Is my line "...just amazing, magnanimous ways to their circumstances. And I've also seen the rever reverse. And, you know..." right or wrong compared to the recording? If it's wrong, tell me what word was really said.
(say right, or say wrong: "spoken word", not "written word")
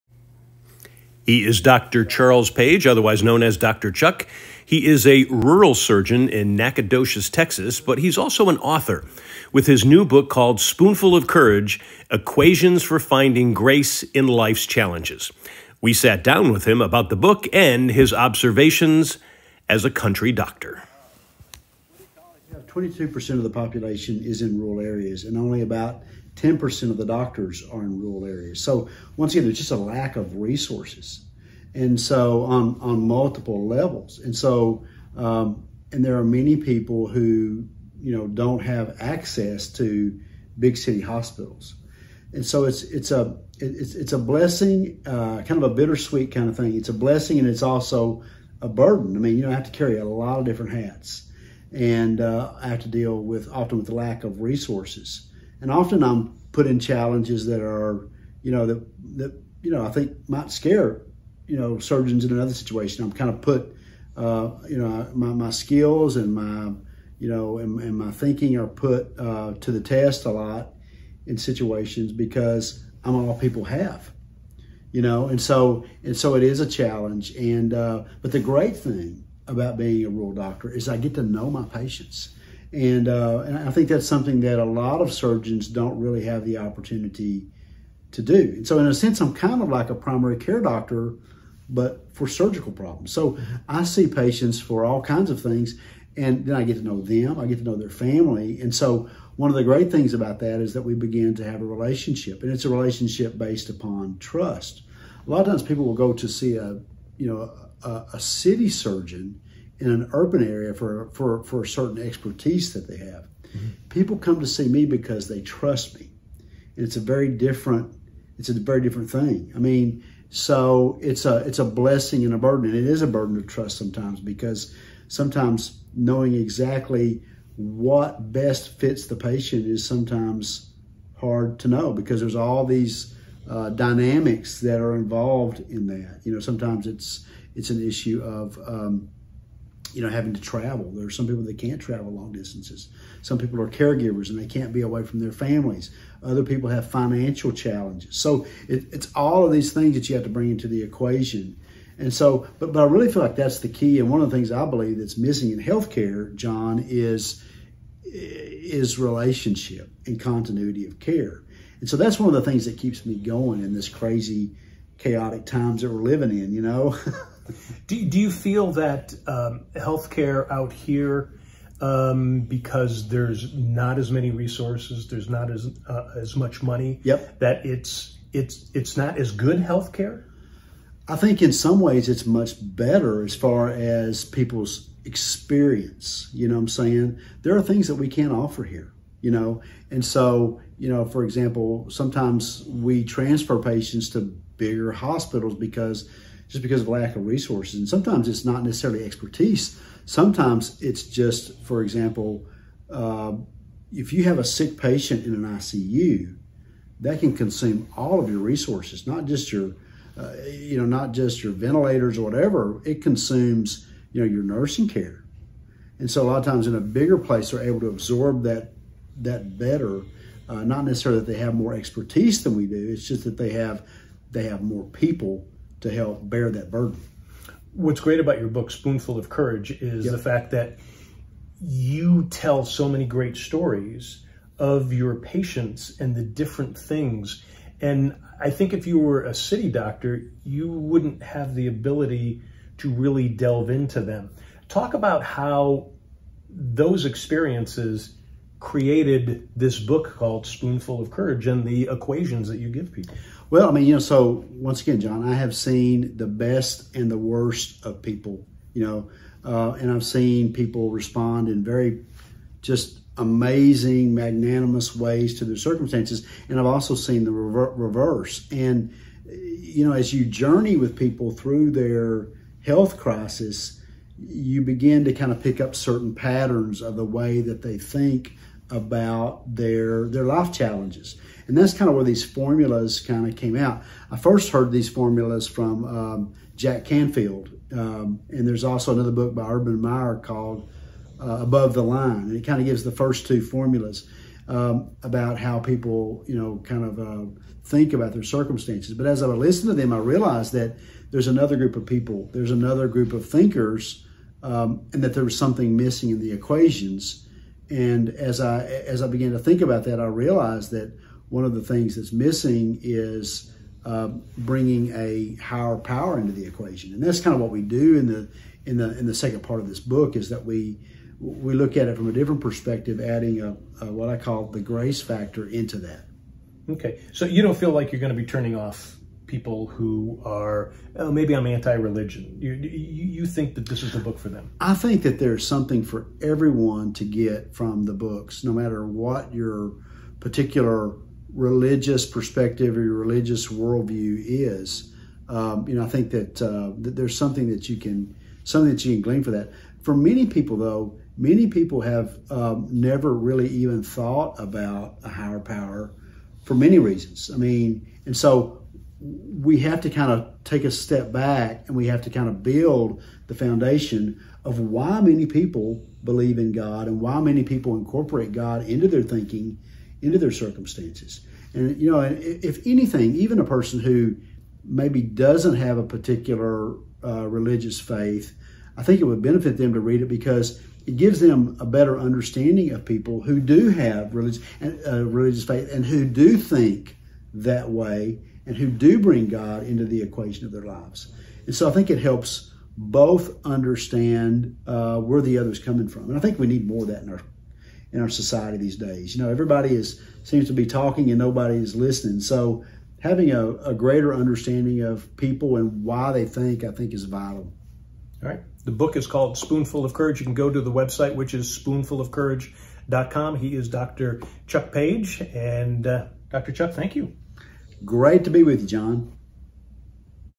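right.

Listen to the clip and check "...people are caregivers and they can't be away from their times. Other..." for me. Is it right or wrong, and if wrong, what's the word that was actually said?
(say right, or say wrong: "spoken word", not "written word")
wrong: "families", not "times".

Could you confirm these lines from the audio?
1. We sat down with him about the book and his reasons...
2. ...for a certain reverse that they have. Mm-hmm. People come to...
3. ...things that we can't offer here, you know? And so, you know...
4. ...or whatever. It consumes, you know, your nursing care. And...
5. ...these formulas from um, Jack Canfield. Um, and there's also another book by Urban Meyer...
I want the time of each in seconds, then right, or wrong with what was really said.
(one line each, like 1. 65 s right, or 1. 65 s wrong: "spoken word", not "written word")
1. 15 s wrong: "observations", not "reasons"
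2. 111 s wrong: "expertise", not "reverse"
3. 187 s right
4. 212 s right
5. 284 s right.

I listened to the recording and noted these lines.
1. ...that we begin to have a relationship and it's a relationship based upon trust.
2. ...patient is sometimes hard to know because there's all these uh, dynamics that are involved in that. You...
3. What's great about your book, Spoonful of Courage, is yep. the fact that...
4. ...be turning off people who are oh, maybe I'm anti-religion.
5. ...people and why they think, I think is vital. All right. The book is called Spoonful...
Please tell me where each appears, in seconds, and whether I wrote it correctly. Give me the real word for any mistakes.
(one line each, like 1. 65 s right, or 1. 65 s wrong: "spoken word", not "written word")
1. 100 s right
2. 129 s right
3. 227 s right
4. 328 s right
5. 405 s right.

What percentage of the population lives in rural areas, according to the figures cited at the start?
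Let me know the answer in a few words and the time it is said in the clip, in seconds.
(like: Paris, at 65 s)
22%, at 22 s.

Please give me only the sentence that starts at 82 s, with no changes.
And, uh, and I think that's something that a lot of surgeons don't really have the opportunity to do.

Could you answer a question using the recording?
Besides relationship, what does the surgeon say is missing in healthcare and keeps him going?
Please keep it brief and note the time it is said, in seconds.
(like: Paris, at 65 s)
continuity of care, at 160 s.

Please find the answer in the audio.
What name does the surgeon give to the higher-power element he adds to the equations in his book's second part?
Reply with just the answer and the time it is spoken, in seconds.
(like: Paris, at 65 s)
grace factor, at 324 s.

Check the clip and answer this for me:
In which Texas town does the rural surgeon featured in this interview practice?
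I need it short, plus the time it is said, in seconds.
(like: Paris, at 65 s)
Nacogdoches, at 6 s.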